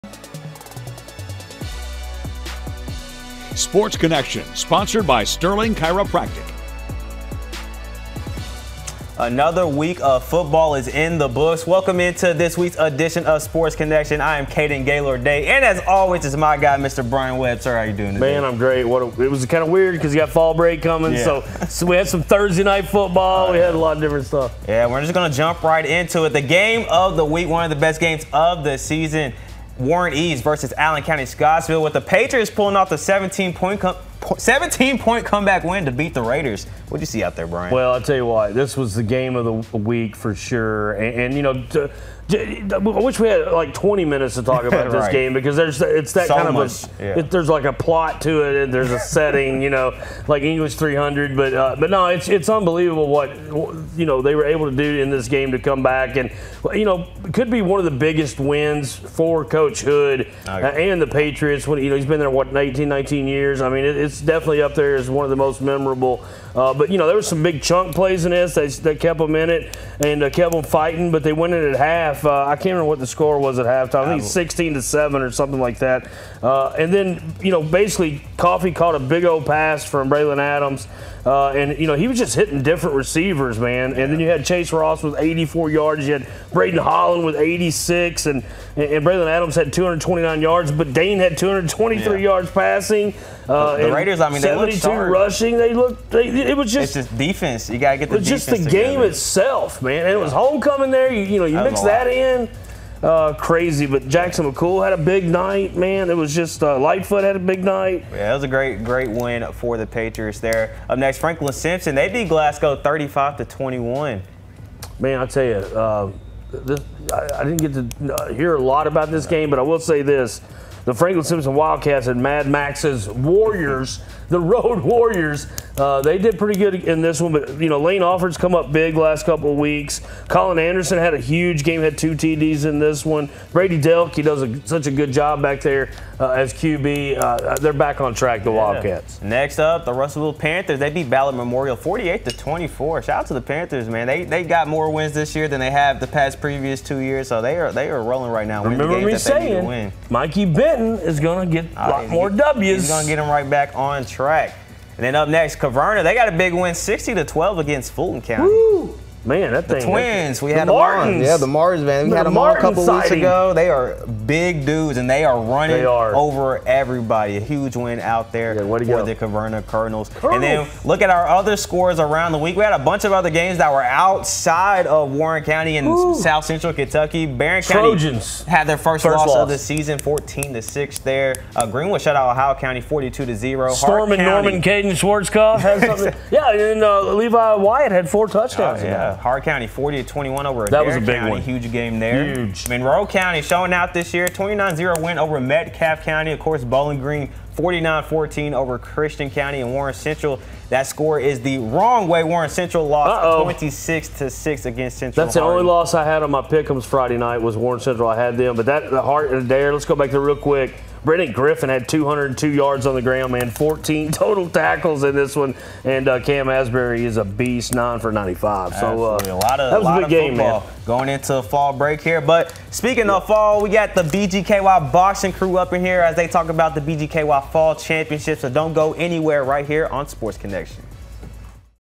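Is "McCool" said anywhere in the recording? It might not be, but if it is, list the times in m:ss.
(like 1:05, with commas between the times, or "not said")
1:44.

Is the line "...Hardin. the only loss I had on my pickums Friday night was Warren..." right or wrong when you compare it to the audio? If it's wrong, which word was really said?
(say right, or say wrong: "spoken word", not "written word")
right.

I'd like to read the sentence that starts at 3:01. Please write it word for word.
Uh, Greenwood shut out Ohio County 42 to 0.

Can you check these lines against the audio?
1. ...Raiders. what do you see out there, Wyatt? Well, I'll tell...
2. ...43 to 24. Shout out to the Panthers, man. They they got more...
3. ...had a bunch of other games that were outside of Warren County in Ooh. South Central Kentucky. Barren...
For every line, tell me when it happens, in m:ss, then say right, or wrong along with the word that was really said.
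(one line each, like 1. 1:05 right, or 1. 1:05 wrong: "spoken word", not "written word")
1. 0:36 wrong: "Brian", not "Wyatt"
2. 2:21 wrong: "48", not "43"
3. 2:52 right.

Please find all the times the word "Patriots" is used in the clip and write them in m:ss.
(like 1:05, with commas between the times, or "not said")
0:32, 1:01, 1:49.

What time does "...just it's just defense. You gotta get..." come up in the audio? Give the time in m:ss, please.
1:36.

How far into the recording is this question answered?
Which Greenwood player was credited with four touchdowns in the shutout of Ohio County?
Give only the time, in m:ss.
3:07.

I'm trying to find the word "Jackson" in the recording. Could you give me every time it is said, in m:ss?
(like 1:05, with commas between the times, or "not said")
1:44.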